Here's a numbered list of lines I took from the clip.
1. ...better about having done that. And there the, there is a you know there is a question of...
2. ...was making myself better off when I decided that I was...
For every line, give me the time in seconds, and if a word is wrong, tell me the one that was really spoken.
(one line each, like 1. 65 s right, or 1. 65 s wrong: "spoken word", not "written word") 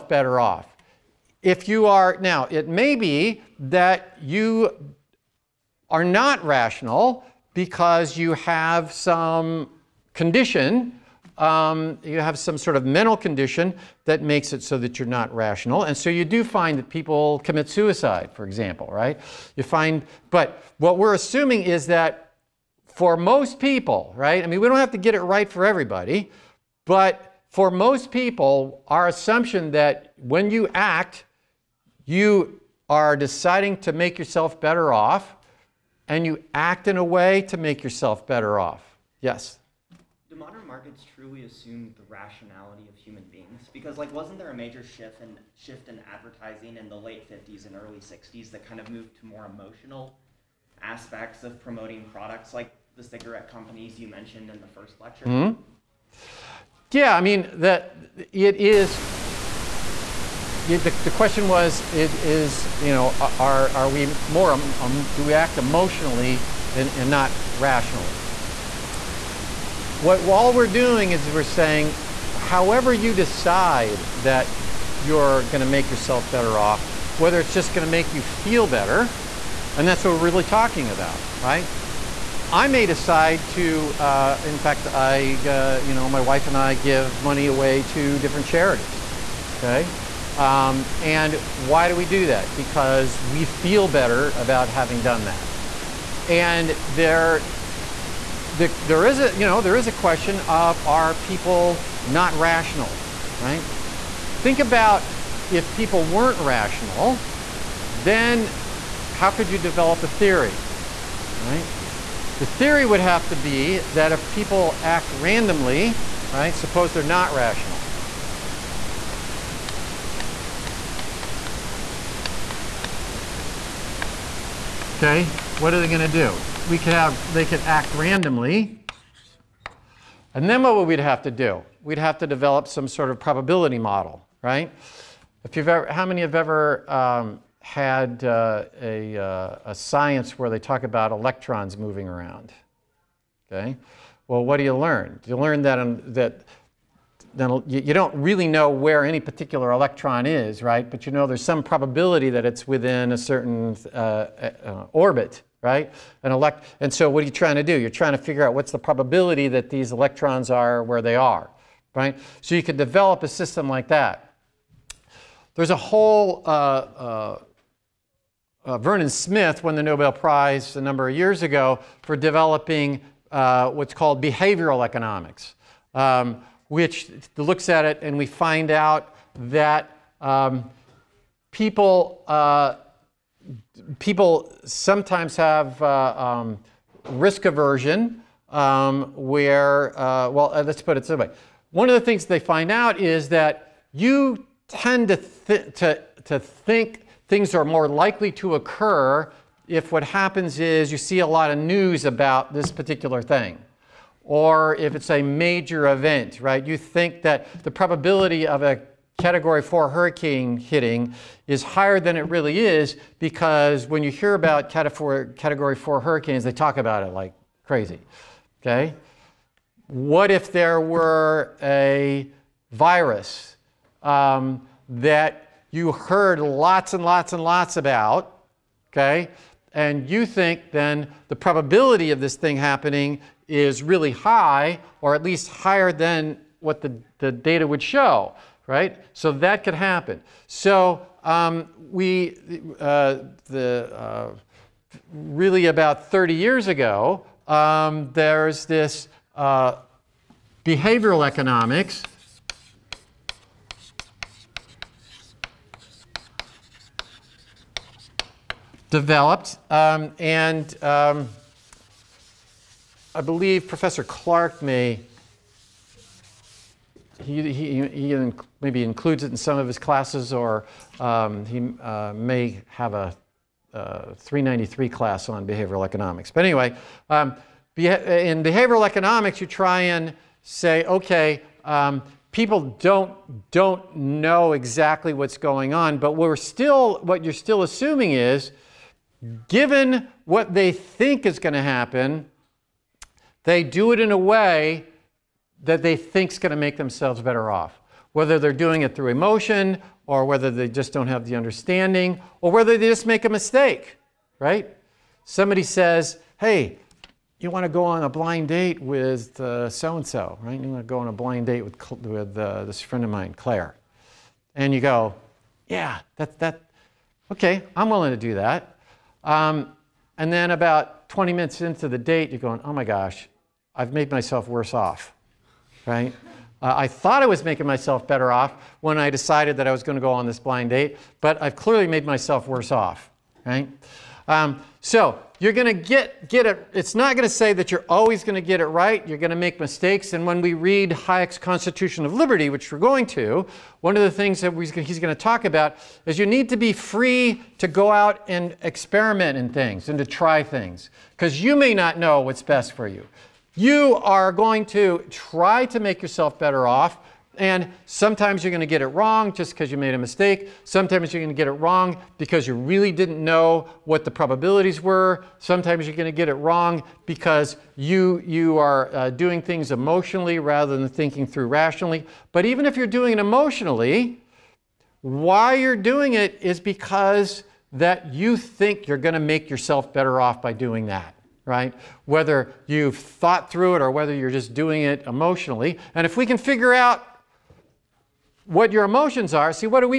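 1. 93 s right
2. 327 s right.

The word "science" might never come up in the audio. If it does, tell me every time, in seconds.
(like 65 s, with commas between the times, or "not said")
139 s.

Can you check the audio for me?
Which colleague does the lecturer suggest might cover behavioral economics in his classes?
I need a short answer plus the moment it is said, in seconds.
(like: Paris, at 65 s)
Professor Clark, at 263 s.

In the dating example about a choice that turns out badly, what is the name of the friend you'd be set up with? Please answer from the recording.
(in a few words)
Claire.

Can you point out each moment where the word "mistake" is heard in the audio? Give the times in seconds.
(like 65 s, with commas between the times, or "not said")
303 s, 339 s, 359 s.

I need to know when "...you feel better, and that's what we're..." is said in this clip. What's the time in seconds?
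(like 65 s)
78 s.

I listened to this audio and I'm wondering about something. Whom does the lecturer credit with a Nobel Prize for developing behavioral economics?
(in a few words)
Vernon Smith.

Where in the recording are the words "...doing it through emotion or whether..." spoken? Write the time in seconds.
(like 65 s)
298 s.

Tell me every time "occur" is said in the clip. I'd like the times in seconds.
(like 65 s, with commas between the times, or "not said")
198 s.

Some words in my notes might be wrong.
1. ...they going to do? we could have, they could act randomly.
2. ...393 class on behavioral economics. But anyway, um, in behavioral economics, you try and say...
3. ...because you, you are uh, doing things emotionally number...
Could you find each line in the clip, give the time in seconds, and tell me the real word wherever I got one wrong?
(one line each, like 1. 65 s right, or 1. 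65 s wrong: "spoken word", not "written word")
1. 125 s right
2. 274 s right
3. 367 s wrong: "rather", not "number".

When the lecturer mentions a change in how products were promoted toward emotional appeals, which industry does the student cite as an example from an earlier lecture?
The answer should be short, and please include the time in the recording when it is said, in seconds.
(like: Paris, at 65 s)
Cigarette companies, at 53 s.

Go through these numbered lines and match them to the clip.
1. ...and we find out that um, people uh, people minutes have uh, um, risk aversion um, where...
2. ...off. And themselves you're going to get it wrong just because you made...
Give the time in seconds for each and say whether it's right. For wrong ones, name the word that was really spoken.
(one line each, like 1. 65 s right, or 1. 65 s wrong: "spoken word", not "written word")
1. 178 s wrong: "sometimes", not "minutes"
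2. 356 s wrong: "sometimes", not "themselves".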